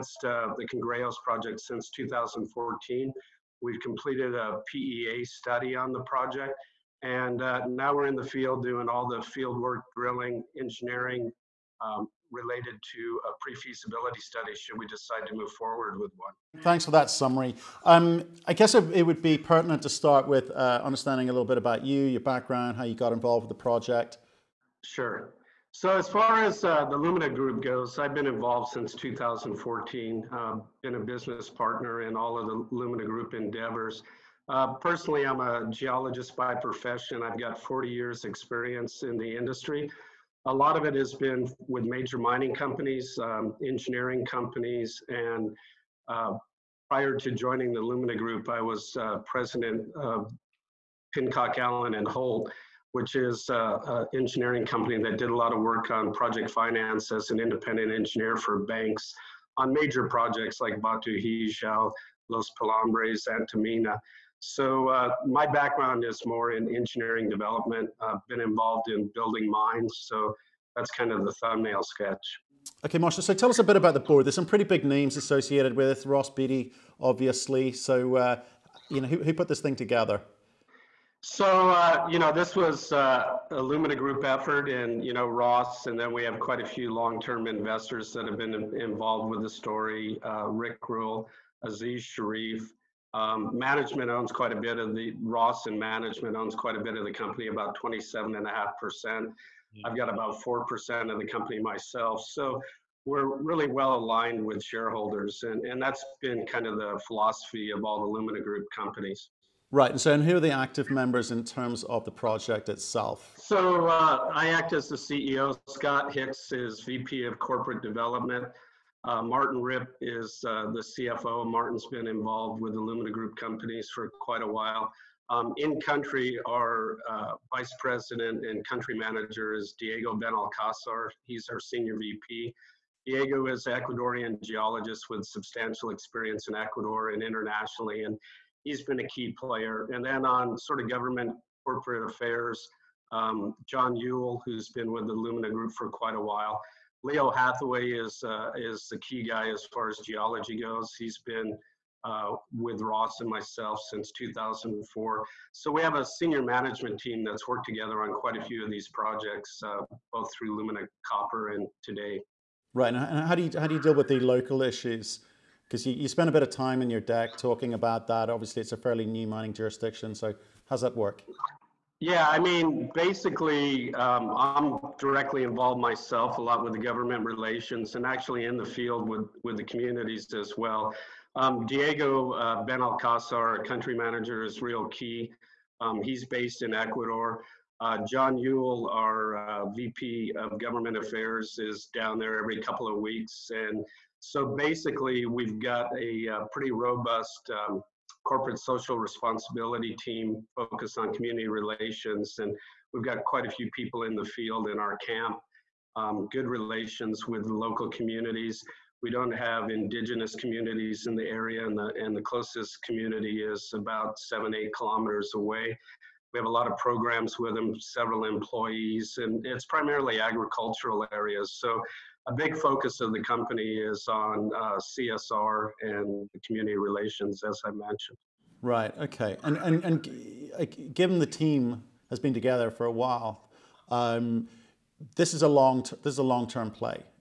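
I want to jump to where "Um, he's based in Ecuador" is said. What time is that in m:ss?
3:05.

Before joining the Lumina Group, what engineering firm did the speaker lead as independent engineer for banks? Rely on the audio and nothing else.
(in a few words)
Pincock Allen and Holt.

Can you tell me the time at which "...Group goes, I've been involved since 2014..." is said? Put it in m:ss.
0:27.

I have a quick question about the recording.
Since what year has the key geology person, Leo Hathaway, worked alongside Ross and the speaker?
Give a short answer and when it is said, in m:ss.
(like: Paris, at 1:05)
2004, at 2:34.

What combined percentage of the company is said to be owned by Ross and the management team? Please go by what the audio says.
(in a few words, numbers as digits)
27.5%.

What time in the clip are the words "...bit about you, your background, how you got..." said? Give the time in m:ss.
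0:21.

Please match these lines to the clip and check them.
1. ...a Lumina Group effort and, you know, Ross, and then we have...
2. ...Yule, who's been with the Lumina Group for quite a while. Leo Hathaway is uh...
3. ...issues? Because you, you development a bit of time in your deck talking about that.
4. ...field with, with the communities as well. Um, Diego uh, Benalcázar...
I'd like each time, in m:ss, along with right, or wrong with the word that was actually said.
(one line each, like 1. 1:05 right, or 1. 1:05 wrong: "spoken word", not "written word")
1. 1:23 right
2. 2:23 right
3. 2:44 wrong: "spent", not "development"
4. 2:58 right.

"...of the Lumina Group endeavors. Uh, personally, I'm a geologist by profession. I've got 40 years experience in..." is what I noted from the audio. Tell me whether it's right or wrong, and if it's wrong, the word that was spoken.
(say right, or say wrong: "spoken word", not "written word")
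right.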